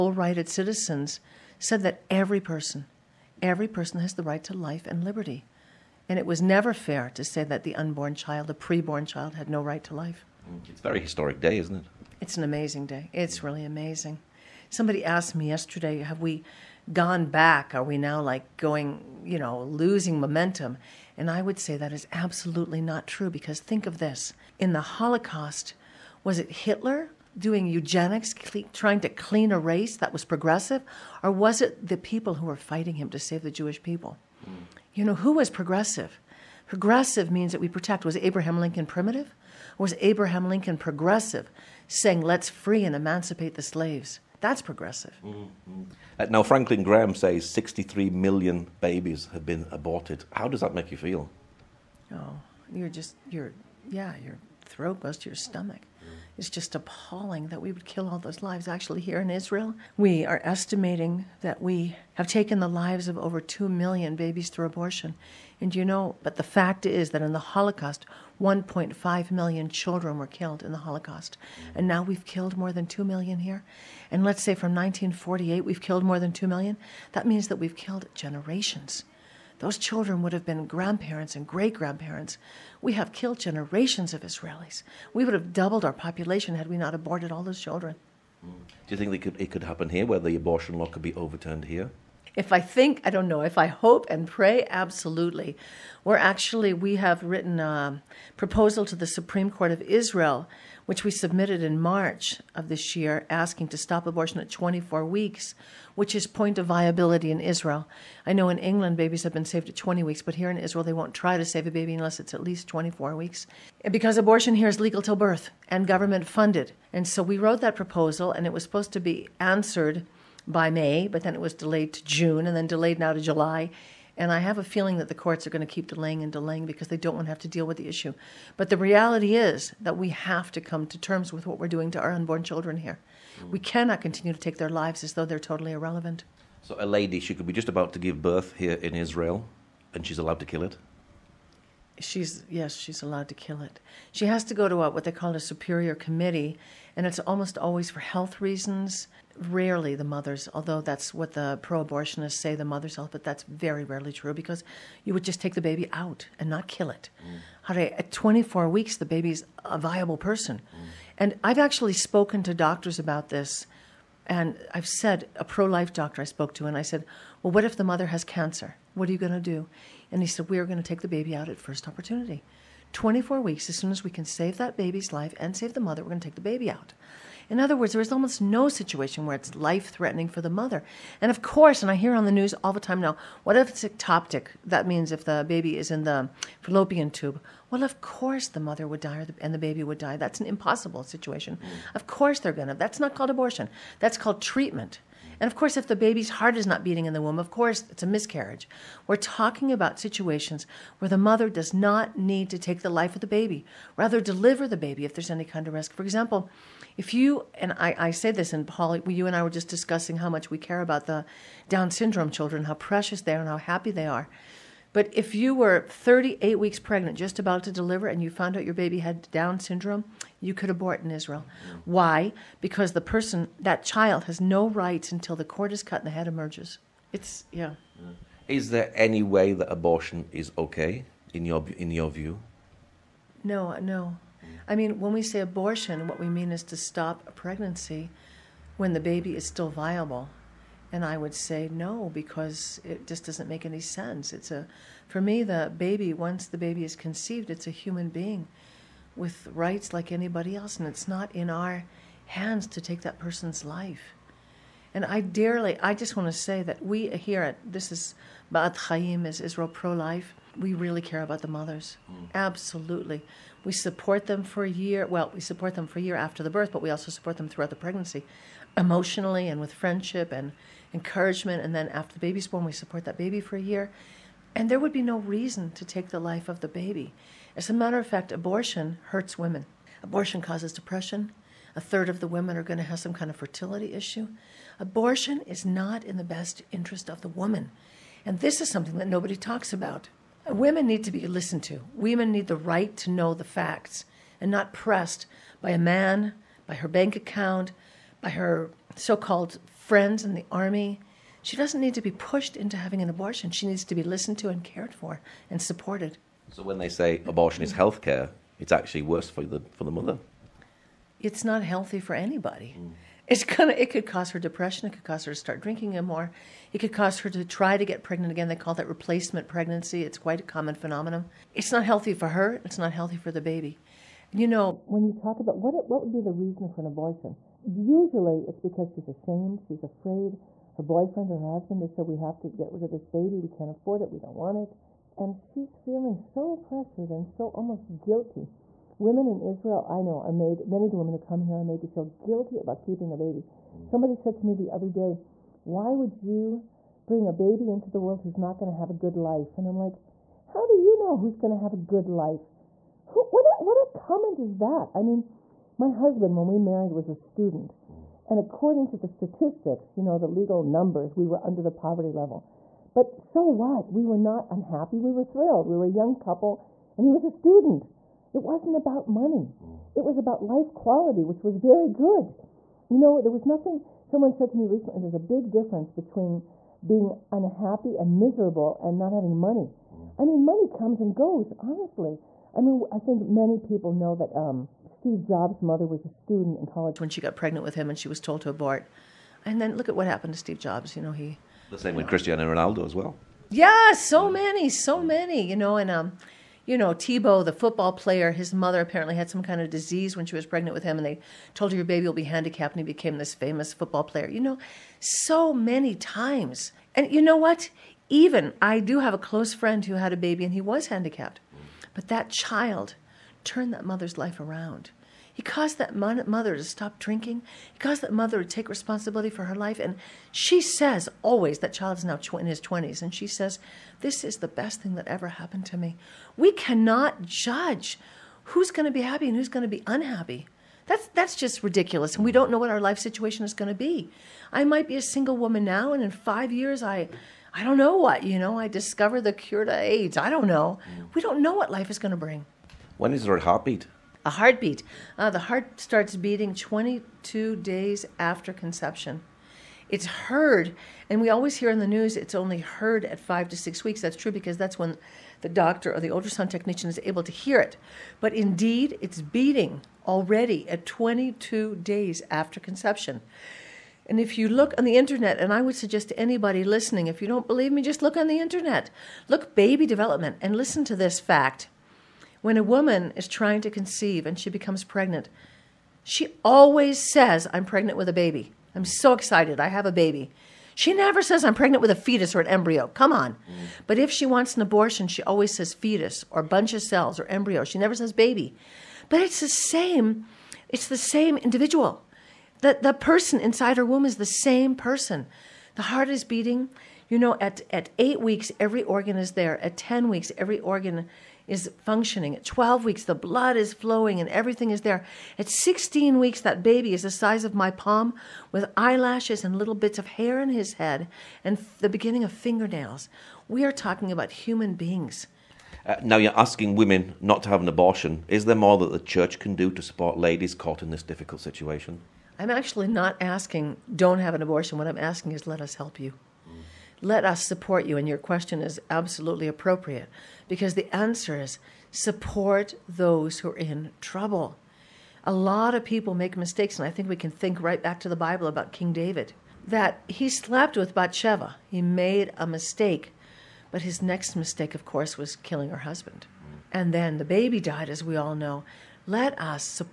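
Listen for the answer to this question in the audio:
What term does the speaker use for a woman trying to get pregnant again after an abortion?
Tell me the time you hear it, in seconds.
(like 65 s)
318 s.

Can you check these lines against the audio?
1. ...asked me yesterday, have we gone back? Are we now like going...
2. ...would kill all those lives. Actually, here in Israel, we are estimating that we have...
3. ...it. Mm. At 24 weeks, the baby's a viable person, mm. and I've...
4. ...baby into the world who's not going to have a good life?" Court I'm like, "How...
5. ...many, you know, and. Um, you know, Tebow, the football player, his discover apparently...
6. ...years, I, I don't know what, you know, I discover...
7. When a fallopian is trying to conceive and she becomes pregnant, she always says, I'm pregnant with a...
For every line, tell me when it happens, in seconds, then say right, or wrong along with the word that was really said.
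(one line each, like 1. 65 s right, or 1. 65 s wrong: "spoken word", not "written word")
1. 15 s right
2. 57 s right
3. 156 s right
4. 347 s wrong: "And", not "Court"
5. 395 s wrong: "mother", not "discover"
6. 436 s right
7. 472 s wrong: "woman", not "fallopian".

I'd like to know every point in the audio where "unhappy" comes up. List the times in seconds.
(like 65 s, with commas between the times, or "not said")
364 s, 377 s, 429 s.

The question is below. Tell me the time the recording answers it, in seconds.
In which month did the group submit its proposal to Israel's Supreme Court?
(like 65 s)
101 s.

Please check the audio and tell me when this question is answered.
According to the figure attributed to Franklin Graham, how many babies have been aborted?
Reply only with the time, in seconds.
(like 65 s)
47 s.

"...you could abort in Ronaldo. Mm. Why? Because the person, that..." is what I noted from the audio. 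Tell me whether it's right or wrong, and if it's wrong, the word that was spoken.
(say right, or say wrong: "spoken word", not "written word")
wrong: "Israel", not "Ronaldo".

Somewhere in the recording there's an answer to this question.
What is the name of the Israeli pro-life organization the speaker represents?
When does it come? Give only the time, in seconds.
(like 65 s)
258 s.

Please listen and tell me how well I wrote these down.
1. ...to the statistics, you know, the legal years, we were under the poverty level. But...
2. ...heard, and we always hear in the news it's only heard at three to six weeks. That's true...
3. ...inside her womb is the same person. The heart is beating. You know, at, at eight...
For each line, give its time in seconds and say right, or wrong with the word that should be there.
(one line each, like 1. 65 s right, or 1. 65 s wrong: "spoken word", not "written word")
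1. 358 s wrong: "numbers", not "years"
2. 450 s wrong: "five", not "three"
3. 493 s right.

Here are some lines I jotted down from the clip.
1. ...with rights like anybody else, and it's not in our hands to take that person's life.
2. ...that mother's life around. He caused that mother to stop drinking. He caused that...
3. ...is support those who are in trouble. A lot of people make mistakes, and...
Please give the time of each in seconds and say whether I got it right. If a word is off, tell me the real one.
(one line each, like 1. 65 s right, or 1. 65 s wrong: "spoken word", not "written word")
1. 249 s right
2. 413 s right
3. 531 s right.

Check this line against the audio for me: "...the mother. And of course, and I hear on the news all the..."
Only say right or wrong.
right.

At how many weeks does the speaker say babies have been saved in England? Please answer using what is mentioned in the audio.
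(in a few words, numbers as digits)
20 weeks.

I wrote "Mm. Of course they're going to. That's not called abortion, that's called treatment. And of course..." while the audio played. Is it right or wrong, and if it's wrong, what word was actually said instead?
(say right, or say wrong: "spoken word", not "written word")
right.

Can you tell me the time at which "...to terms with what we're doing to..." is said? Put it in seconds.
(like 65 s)
130 s.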